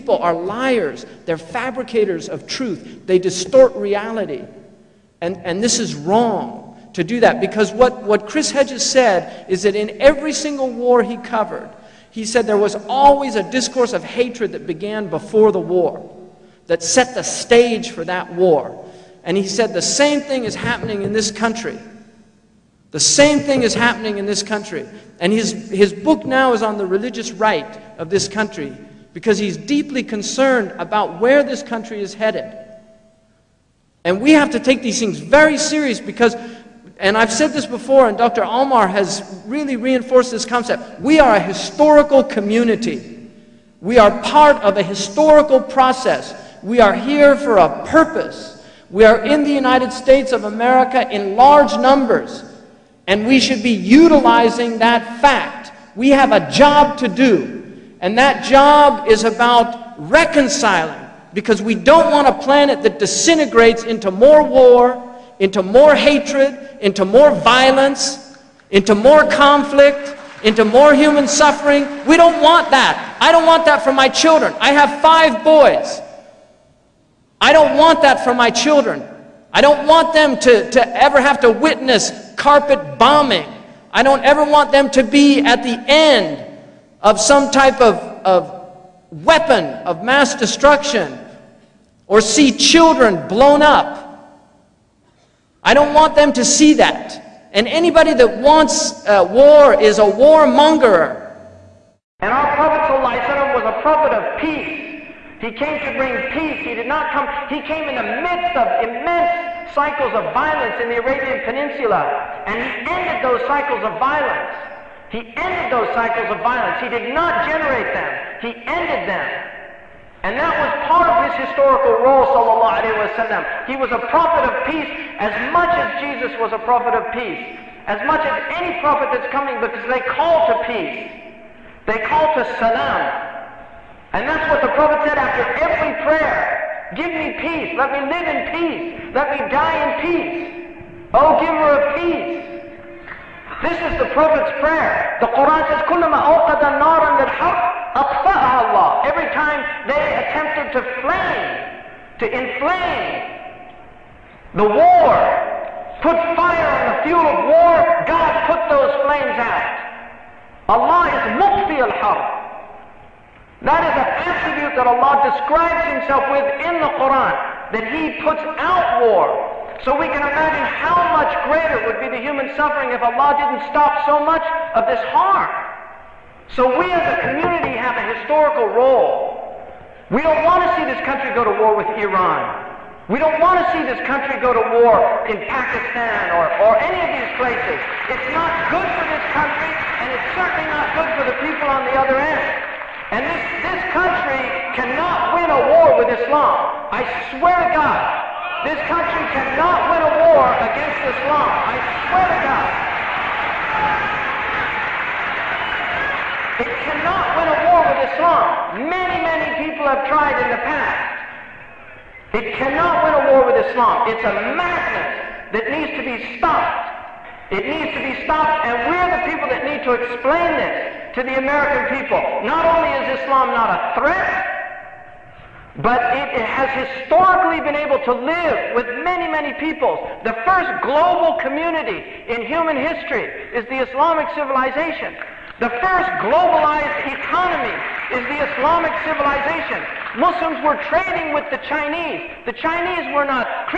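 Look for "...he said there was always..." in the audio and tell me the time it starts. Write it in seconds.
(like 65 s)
12 s.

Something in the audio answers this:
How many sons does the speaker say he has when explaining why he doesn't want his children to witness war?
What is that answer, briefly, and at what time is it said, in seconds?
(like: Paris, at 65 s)
5, at 75 s.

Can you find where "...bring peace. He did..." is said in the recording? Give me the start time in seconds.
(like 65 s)
105 s.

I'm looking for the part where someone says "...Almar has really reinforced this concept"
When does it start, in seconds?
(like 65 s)
38 s.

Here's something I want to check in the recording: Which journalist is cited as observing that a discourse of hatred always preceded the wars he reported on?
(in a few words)
Chris Hedges.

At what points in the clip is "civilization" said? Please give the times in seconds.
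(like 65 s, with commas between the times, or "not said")
234 s, 239 s.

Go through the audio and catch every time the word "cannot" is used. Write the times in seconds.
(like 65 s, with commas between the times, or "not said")
194 s, 199 s, 206 s, 212 s.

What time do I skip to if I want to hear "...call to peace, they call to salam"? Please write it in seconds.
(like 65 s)
130 s.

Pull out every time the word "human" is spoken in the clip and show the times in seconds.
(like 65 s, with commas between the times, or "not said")
70 s, 172 s, 232 s.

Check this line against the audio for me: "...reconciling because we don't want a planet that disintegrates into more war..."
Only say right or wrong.
right.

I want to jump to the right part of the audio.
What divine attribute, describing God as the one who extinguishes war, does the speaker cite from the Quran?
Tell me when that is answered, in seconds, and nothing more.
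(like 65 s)
161 s.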